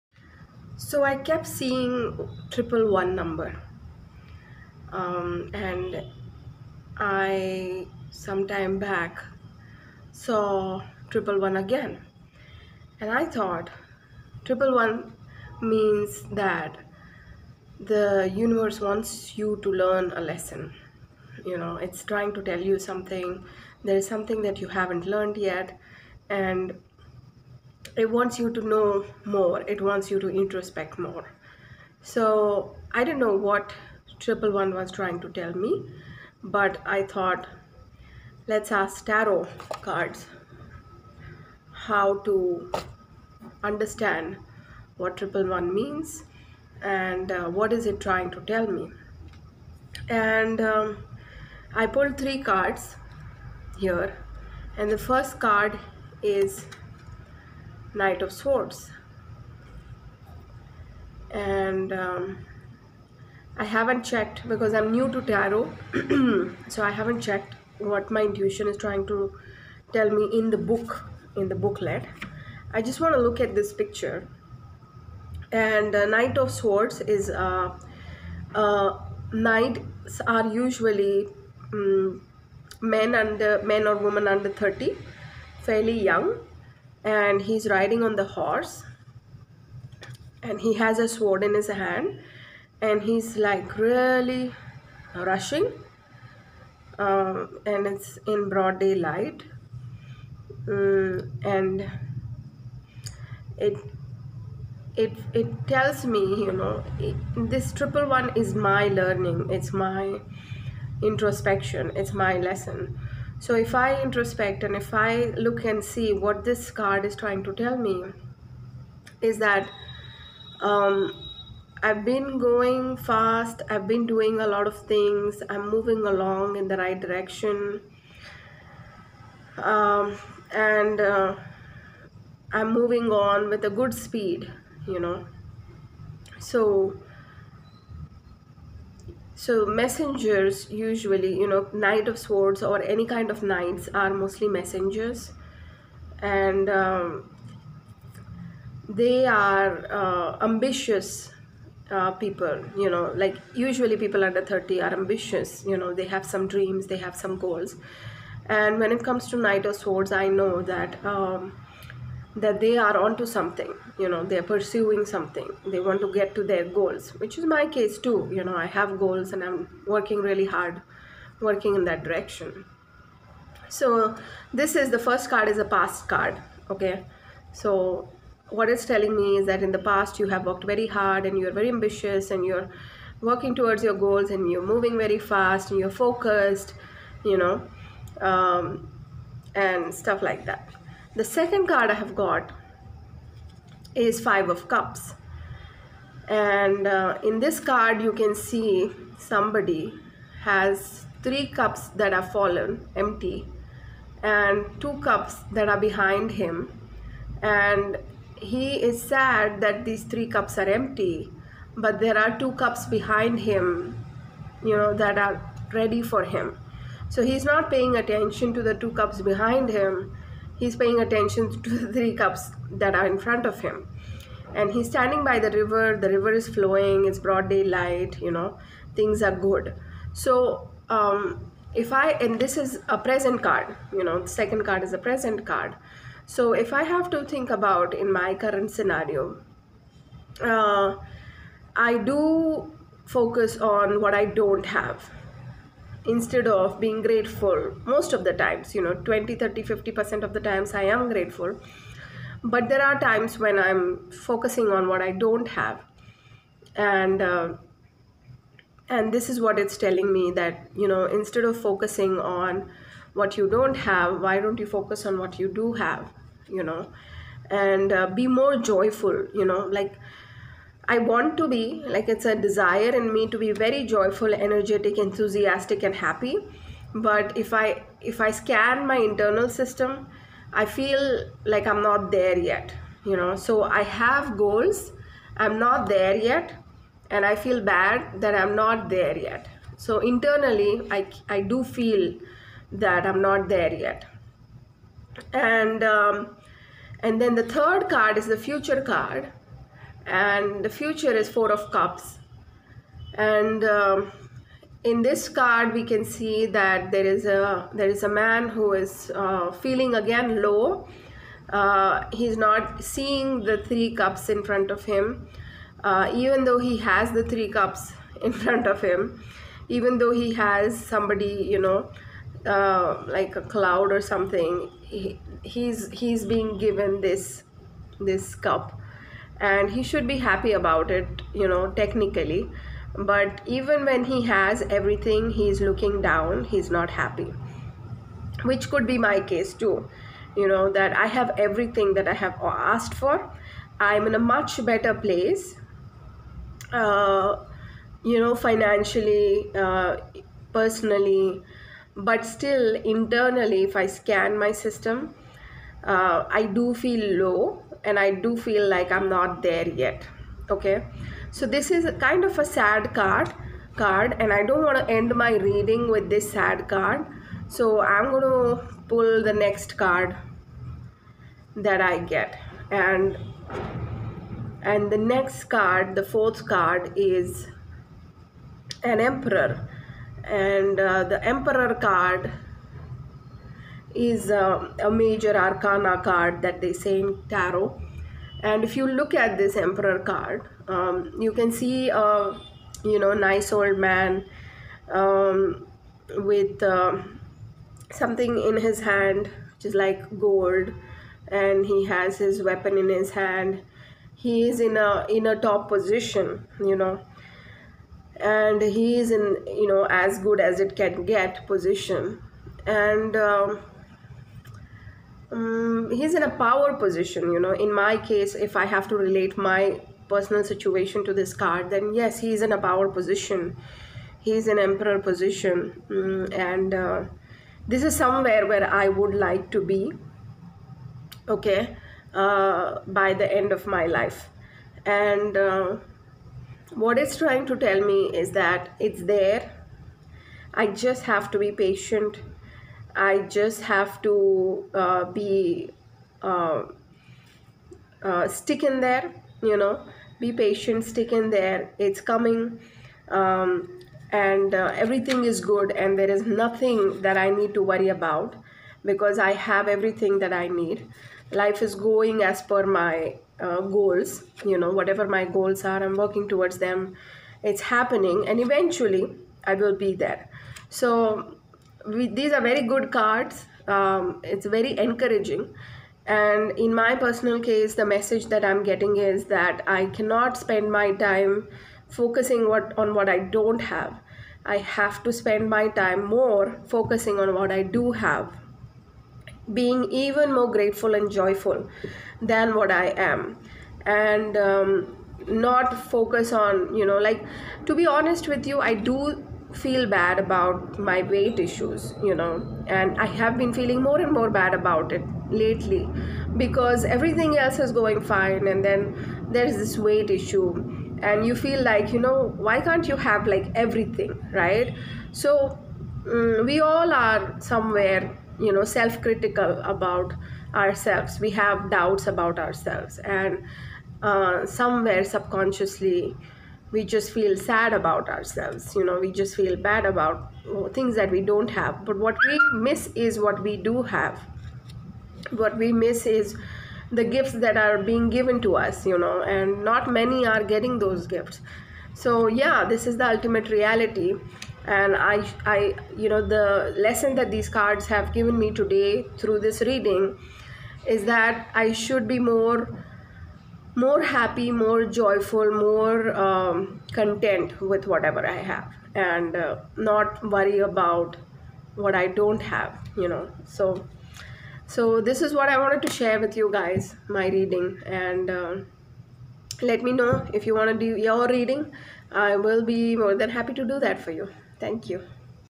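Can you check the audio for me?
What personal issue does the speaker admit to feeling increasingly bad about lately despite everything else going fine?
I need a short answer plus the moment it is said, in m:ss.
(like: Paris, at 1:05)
Weight issues, at 8:21.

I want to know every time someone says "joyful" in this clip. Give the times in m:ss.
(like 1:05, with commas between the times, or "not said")
4:28, 4:33, 8:11, 9:14.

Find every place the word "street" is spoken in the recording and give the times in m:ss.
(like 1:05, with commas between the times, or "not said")
not said.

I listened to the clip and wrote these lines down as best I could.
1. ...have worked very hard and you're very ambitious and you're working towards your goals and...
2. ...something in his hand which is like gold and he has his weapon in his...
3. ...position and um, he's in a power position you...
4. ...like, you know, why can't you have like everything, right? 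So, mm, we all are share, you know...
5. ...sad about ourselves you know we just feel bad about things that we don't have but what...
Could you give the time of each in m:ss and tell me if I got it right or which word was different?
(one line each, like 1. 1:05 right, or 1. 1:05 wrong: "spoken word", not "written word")
1. 3:00 right
2. 6:37 right
3. 6:51 right
4. 8:31 wrong: "somewhere", not "share"
5. 8:47 right.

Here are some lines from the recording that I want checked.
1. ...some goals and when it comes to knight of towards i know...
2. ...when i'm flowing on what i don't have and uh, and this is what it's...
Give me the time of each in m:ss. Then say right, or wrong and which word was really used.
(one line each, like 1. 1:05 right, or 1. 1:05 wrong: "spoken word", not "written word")
1. 2:37 wrong: "swords", not "towards"
2. 4:13 wrong: "focusing", not "flowing".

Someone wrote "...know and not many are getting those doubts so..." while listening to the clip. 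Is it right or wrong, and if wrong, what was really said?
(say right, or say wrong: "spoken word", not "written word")
wrong: "gifts", not "doubts".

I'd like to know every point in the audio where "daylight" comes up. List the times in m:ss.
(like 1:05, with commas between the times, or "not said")
1:38, 3:47.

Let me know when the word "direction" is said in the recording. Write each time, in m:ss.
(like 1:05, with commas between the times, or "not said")
2:07, 2:52.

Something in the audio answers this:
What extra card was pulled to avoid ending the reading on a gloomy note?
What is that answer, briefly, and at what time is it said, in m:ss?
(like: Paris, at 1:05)
The Emperor, at 6:18.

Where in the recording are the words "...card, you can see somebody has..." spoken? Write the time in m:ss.
3:17.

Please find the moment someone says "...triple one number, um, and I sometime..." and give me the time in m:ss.
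0:02.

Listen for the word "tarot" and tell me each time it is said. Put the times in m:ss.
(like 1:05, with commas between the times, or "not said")
0:39, 1:05, 6:27.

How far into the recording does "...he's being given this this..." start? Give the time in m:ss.
5:25.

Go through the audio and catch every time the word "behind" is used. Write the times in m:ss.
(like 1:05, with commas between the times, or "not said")
3:25, 3:32, 3:39.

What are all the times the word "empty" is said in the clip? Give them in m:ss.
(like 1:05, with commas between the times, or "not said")
3:22, 3:30.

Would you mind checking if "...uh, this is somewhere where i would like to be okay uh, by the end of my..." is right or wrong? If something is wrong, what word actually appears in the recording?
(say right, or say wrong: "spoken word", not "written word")
right.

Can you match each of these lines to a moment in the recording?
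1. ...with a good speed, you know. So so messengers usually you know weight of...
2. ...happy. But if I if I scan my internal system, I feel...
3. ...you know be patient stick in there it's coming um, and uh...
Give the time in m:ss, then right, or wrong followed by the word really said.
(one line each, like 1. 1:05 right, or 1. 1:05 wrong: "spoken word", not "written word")
1. 2:13 wrong: "knight", not "weight"
2. 4:35 right
3. 7:29 right.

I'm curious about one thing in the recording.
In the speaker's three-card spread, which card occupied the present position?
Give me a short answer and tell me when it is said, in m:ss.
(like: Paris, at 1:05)
Five of Cups, at 3:14.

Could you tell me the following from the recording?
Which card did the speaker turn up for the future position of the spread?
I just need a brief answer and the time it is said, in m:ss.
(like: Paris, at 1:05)
Four of Cups, at 5:01.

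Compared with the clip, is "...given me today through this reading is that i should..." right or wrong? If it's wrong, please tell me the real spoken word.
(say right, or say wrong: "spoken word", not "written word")
right.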